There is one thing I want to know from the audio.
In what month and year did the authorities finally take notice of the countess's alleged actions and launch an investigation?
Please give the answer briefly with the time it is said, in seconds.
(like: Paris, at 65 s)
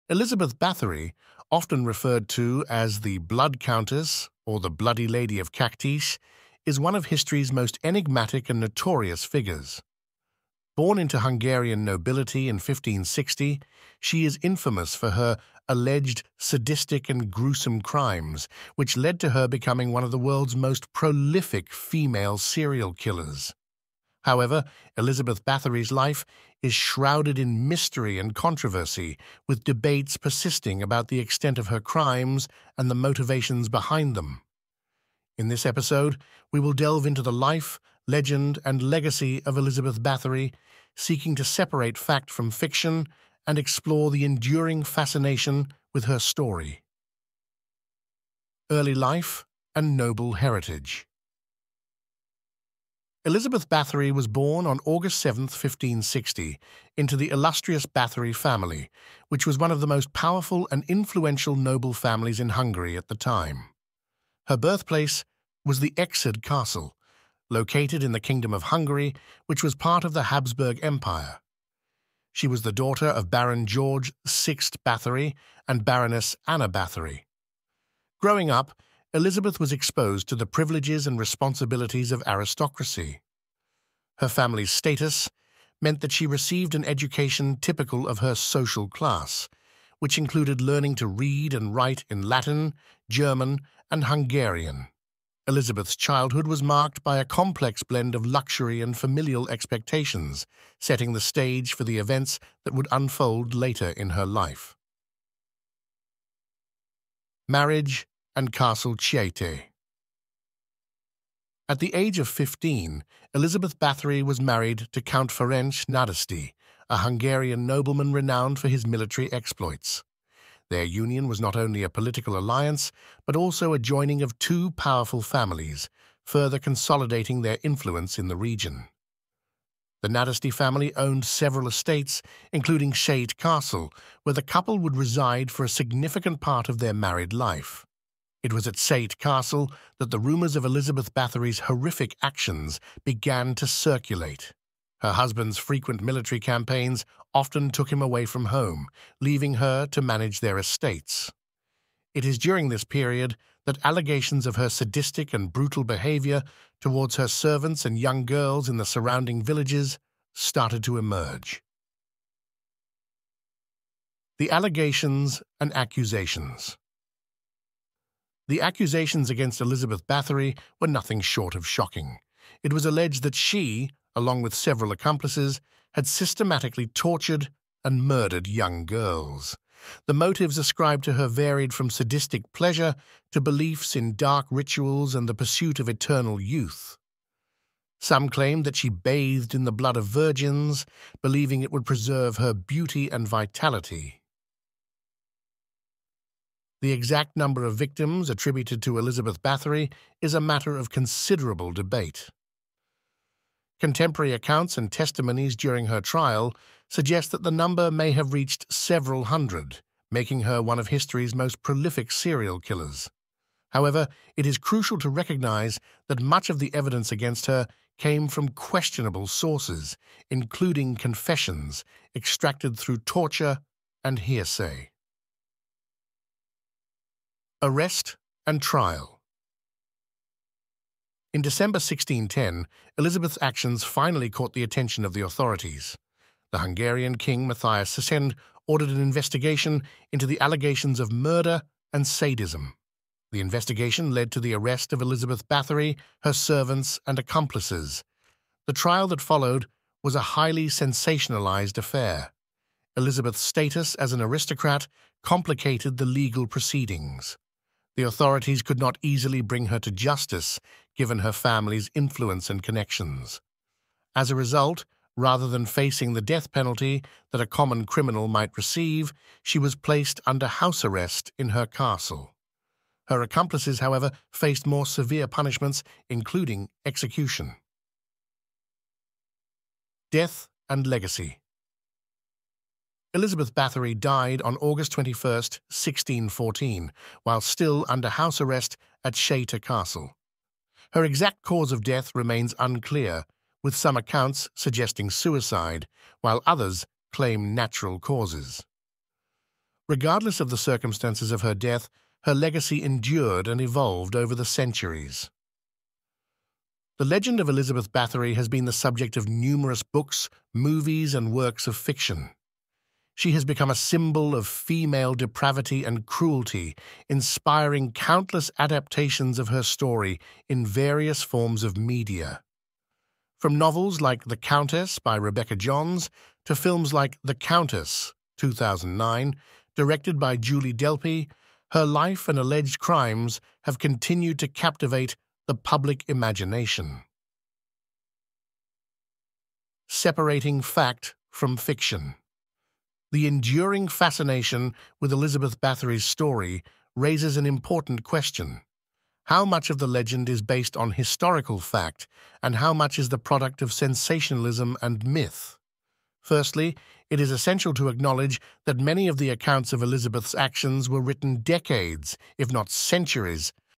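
December 1610, at 231 s.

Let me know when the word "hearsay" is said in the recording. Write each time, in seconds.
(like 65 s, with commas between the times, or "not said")
224 s.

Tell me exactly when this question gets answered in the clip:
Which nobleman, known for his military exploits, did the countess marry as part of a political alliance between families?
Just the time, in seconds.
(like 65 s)
115 s.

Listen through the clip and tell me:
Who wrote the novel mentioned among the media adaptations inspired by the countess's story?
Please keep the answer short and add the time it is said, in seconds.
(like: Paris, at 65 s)
Rebecca Johns, at 325 s.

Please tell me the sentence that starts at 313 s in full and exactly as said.
She has become a symbol of female depravity and cruelty, inspiring countless adaptations of her story in various forms of media.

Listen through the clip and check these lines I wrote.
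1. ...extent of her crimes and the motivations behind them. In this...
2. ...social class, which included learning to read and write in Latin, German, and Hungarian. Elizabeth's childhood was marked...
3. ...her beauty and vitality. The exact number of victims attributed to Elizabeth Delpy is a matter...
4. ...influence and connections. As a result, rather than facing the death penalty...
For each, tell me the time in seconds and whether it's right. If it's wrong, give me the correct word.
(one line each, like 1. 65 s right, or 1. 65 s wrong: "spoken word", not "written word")
1. 31 s right
2. 88 s right
3. 192 s wrong: "Bathory", not "Delpy"
4. 261 s right.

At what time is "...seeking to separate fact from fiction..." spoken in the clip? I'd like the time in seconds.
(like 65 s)
40 s.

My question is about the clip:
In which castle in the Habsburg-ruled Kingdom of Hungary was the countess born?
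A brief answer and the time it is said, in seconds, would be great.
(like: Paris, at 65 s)
Ecsed Castle, at 65 s.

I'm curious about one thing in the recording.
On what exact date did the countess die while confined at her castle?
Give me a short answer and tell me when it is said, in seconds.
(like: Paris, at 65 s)
August 21, 1614, at 284 s.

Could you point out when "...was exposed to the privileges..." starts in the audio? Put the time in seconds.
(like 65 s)
79 s.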